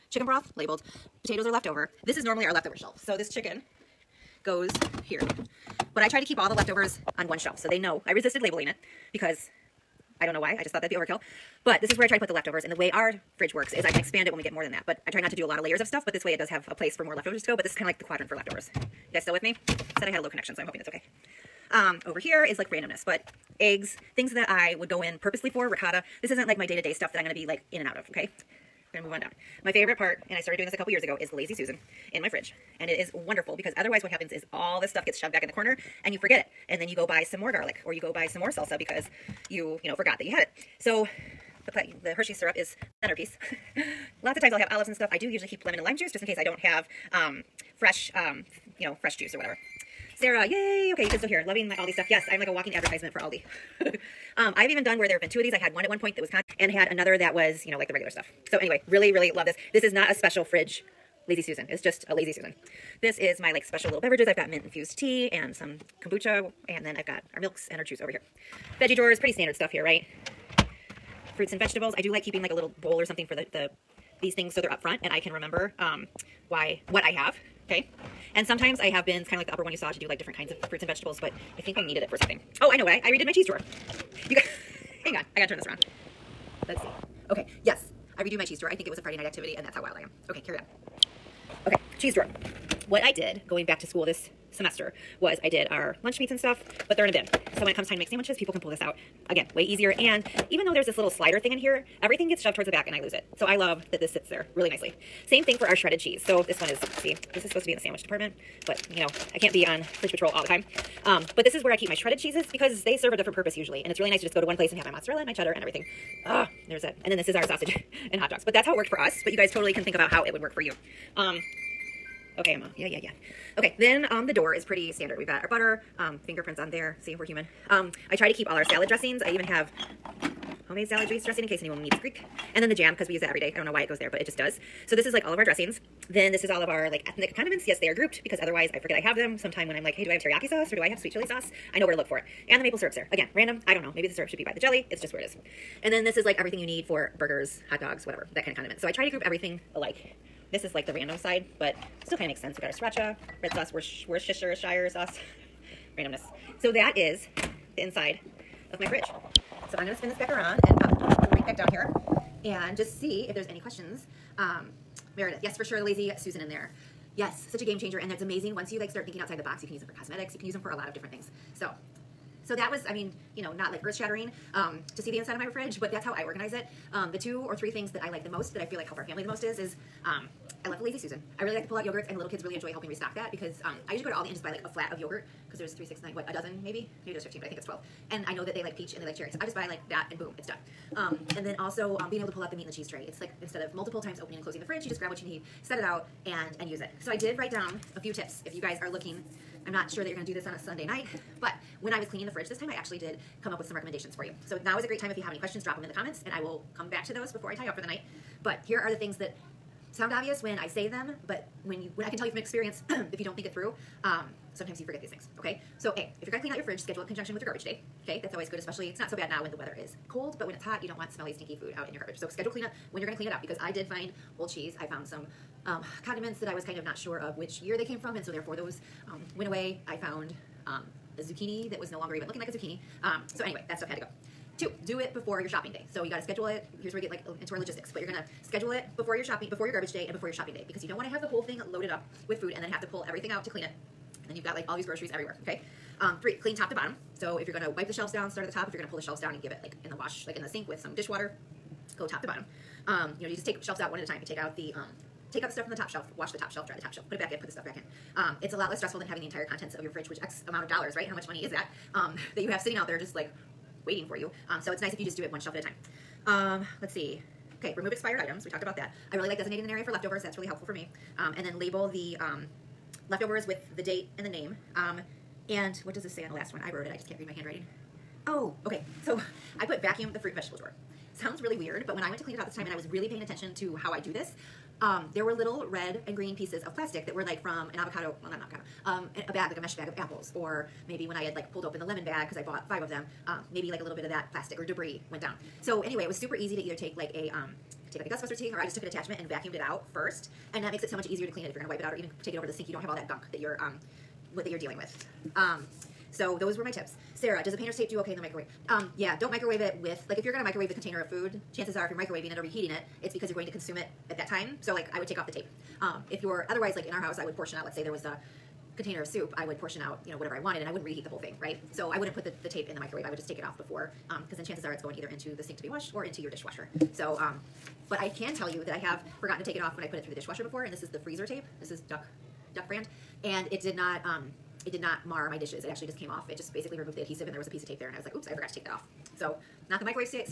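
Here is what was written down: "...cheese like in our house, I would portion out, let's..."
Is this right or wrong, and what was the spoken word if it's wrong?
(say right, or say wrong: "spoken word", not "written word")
wrong: "otherwise", not "cheese".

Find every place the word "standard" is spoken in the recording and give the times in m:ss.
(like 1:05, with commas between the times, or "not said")
1:09, 2:04.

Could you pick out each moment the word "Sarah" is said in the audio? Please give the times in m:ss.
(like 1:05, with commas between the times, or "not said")
0:50, 5:07.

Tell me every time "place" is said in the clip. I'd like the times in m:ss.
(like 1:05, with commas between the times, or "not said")
0:16, 1:54.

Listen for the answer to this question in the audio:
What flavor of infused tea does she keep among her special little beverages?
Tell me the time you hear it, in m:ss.
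1:04.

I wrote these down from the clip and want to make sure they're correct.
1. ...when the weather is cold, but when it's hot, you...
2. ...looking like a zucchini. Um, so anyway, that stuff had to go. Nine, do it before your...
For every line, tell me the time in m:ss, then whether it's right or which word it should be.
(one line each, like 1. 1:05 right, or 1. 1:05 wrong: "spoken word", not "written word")
1. 3:39 right
2. 3:52 wrong: "Two", not "Nine".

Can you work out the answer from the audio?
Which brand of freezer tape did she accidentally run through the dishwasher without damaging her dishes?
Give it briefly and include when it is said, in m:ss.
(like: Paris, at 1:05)
Duck, at 5:32.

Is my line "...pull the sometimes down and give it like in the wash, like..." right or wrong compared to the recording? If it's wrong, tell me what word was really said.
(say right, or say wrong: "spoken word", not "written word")
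wrong: "shelves", not "sometimes".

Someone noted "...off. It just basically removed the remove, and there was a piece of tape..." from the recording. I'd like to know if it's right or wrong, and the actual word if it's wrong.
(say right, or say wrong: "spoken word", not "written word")
wrong: "adhesive", not "remove".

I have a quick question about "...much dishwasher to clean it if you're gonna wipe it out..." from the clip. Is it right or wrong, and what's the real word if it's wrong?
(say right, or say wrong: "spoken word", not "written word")
wrong: "easier", not "dishwasher".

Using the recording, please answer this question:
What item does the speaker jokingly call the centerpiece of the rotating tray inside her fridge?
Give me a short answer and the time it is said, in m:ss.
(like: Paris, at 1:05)
Hershey's syrup, at 0:42.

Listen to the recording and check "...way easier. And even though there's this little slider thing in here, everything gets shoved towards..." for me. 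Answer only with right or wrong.
right.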